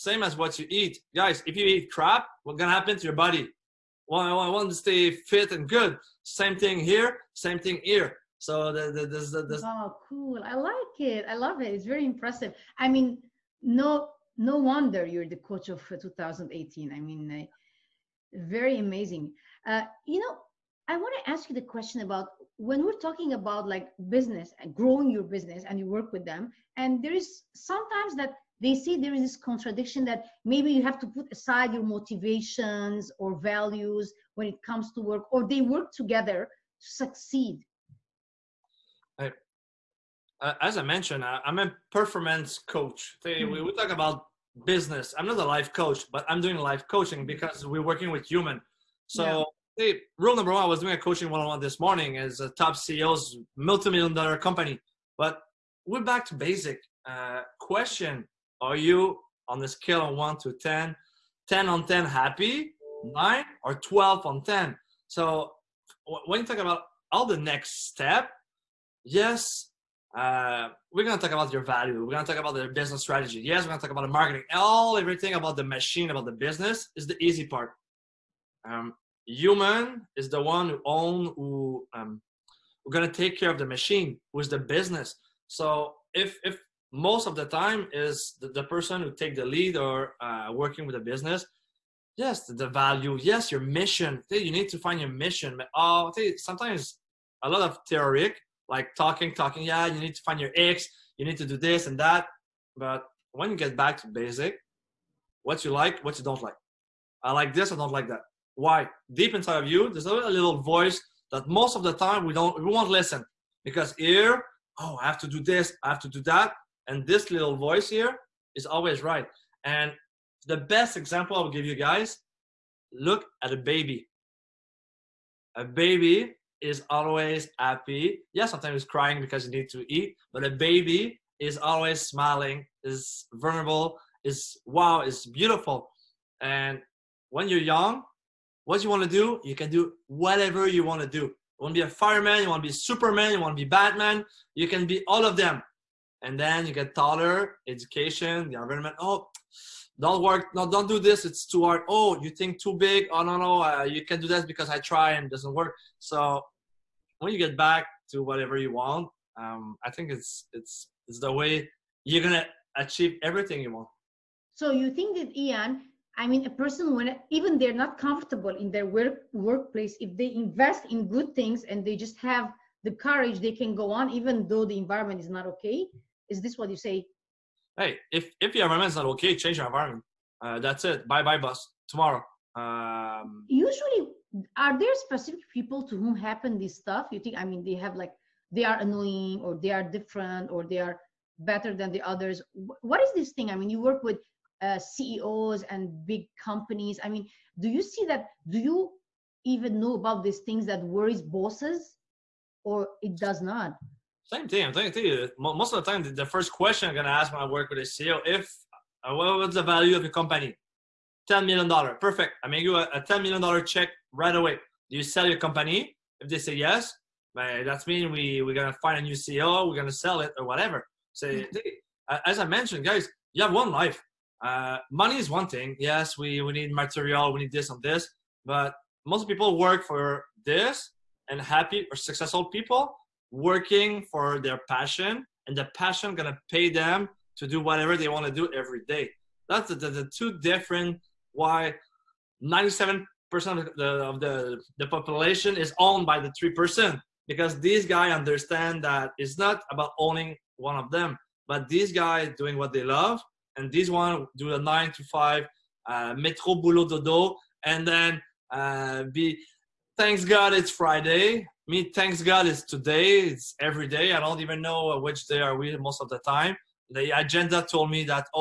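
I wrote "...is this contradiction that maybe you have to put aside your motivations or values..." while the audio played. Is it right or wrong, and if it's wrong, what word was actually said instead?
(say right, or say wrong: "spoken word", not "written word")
right.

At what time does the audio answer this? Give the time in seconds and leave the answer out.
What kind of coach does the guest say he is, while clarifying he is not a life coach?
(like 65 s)
41 s.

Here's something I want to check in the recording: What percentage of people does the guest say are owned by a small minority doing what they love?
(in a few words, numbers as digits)
97%.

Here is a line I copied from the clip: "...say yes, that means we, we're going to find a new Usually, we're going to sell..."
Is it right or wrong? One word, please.
wrong.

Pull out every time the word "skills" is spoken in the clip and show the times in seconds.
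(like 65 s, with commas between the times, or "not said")
not said.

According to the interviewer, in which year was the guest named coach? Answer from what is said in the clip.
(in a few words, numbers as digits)
2018.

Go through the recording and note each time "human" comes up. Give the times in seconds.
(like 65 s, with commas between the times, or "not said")
48 s, 79 s.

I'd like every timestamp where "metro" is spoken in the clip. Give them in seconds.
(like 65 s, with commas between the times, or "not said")
256 s.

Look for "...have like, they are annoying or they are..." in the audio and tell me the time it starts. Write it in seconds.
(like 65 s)
187 s.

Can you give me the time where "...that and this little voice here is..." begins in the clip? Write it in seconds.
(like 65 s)
116 s.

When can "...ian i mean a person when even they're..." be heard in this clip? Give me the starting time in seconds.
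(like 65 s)
165 s.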